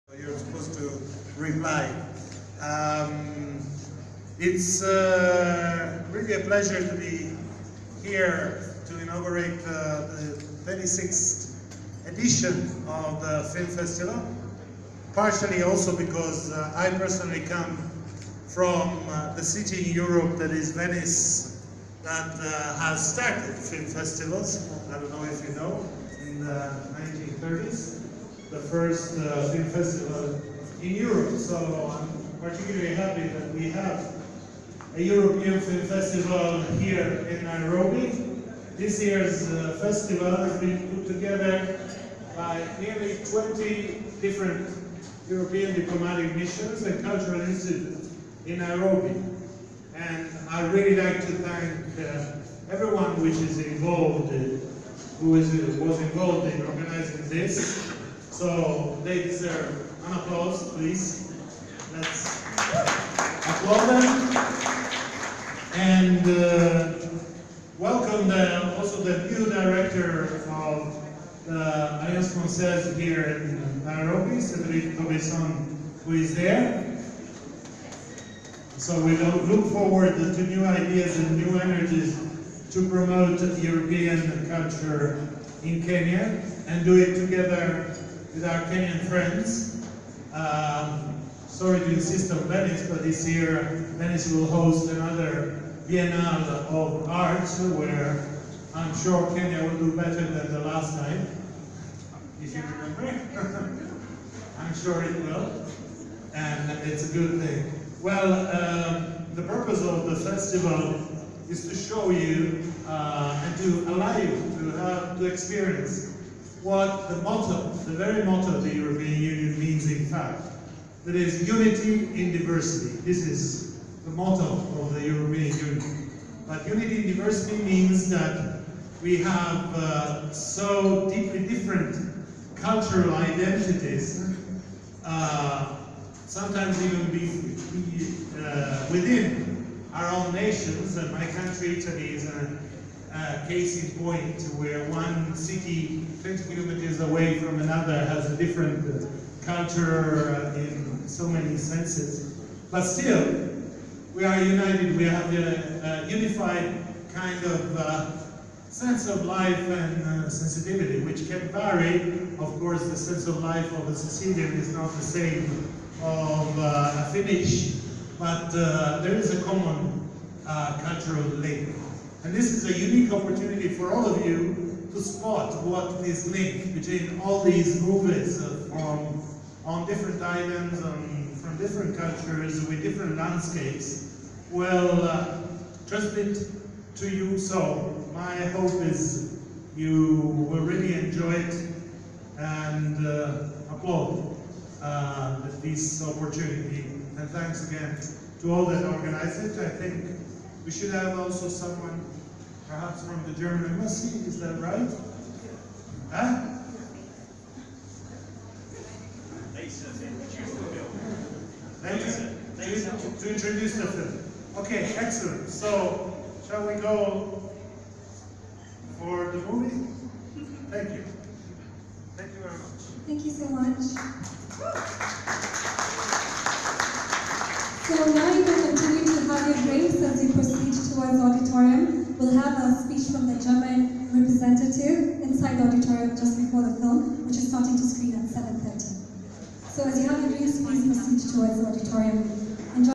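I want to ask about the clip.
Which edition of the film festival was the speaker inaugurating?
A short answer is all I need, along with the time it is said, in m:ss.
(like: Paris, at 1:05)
26th, at 0:10.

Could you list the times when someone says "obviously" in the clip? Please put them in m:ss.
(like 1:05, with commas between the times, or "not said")
not said.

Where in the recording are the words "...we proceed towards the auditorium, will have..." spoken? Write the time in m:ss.
3:50.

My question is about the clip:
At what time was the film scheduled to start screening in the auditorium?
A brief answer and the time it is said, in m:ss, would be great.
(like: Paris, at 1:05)
7:30, at 3:58.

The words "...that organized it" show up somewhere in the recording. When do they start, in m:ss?
3:18.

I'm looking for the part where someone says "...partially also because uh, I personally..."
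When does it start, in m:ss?
0:15.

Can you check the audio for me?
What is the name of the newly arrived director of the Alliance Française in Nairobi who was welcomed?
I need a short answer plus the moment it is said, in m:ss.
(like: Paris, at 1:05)
Cédric Cobesson, at 1:14.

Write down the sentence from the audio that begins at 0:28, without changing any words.
The first uh, film festival in Europe.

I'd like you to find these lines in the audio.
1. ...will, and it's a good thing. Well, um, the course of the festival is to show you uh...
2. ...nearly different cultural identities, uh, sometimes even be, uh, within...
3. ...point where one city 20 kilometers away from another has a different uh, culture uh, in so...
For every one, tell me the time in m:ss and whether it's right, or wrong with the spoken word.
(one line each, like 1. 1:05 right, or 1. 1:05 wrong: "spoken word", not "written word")
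1. 1:45 wrong: "purpose", not "course"
2. 2:11 wrong: "deeply", not "nearly"
3. 2:24 right.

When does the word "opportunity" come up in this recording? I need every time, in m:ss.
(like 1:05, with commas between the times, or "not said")
2:53, 3:16.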